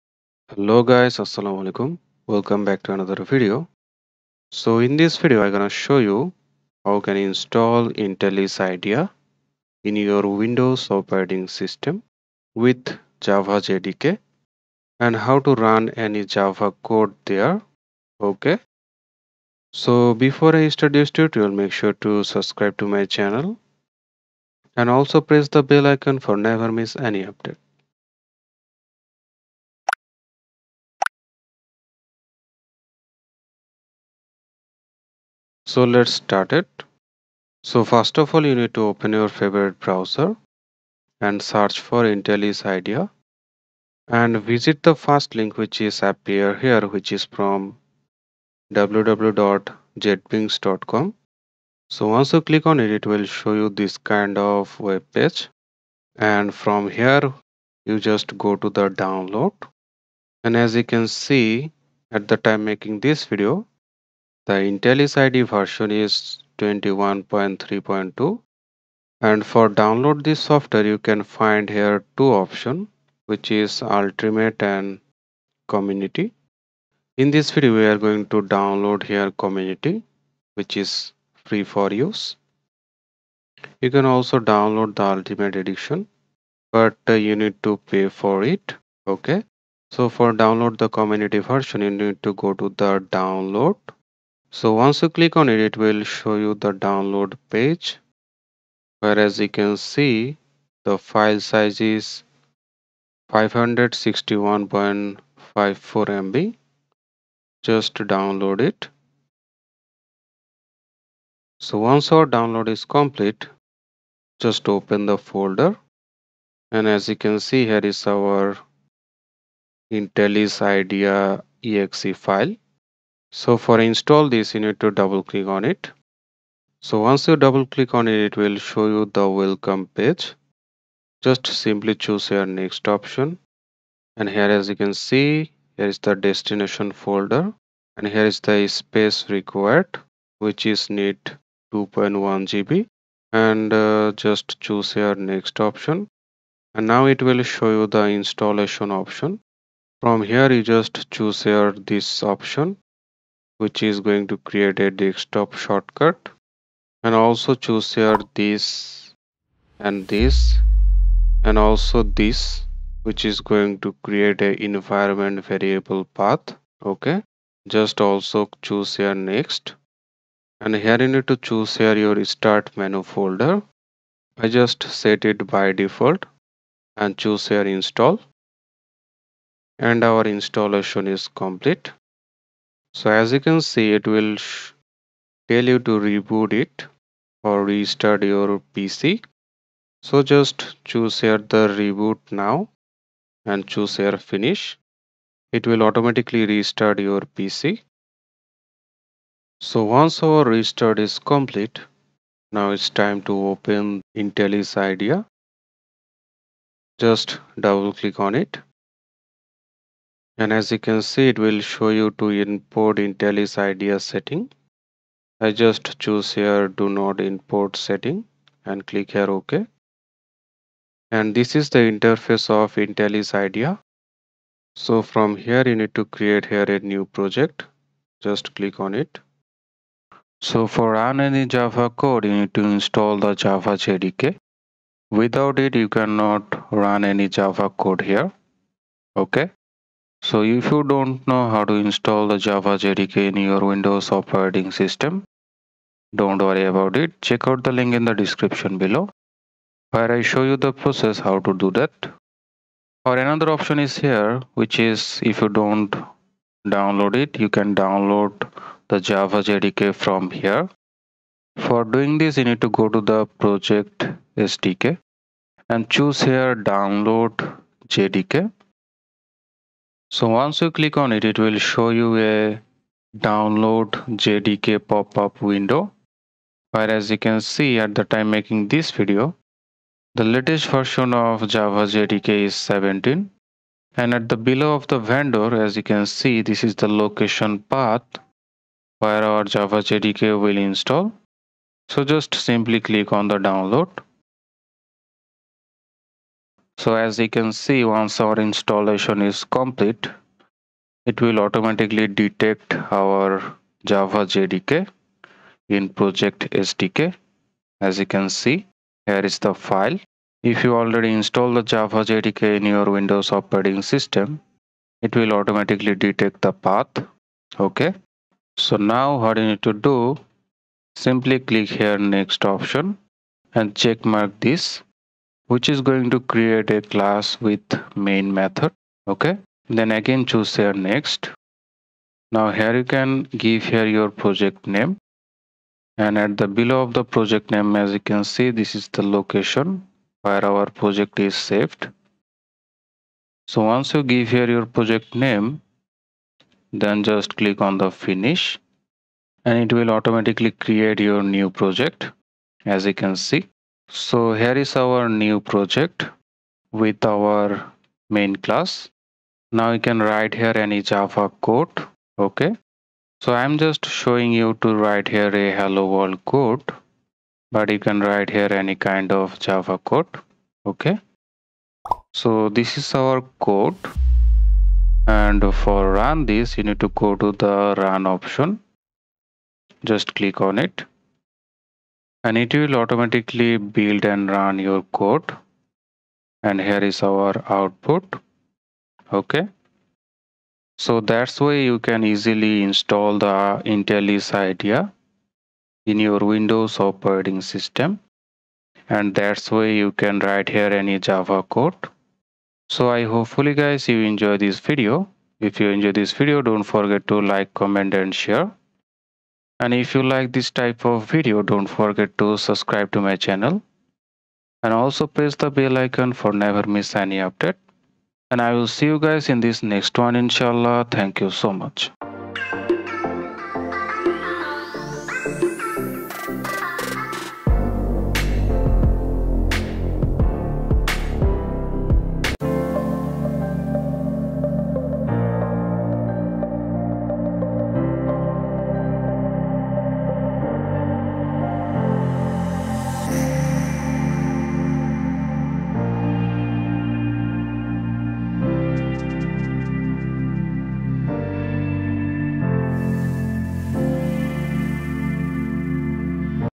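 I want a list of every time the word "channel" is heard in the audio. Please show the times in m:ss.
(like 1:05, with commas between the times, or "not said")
0:23, 6:53.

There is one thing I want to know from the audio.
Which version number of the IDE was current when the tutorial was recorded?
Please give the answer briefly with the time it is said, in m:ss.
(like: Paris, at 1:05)
21.3.2, at 1:06.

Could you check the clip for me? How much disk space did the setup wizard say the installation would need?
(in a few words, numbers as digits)
2.1 GB.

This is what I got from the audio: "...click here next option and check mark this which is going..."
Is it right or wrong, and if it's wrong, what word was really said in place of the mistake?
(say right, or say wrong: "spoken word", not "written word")
right.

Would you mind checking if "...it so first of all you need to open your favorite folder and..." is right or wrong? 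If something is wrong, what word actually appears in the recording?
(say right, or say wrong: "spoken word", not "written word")
wrong: "browser", not "folder".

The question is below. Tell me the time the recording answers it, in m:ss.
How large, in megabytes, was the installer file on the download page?
1:43.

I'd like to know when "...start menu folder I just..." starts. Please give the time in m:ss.
2:52.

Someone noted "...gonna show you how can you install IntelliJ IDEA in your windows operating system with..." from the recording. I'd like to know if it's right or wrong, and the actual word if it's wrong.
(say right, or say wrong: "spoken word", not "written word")
right.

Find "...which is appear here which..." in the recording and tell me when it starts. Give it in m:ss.
0:45.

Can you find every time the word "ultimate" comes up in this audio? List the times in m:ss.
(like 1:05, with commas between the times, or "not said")
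1:13, 1:25.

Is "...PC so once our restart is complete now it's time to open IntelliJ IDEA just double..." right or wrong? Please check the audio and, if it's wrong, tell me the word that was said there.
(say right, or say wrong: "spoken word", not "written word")
right.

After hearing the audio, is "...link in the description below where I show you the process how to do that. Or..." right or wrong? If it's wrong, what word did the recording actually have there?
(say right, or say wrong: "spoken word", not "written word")
right.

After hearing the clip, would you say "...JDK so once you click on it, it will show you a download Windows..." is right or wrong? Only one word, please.
wrong.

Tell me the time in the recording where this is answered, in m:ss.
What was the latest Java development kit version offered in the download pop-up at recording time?
4:42.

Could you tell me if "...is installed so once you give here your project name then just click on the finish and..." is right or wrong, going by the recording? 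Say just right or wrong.
wrong.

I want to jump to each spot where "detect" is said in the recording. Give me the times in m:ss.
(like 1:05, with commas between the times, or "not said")
5:02, 5:16.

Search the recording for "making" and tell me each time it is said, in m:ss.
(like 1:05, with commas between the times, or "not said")
1:02, 4:38.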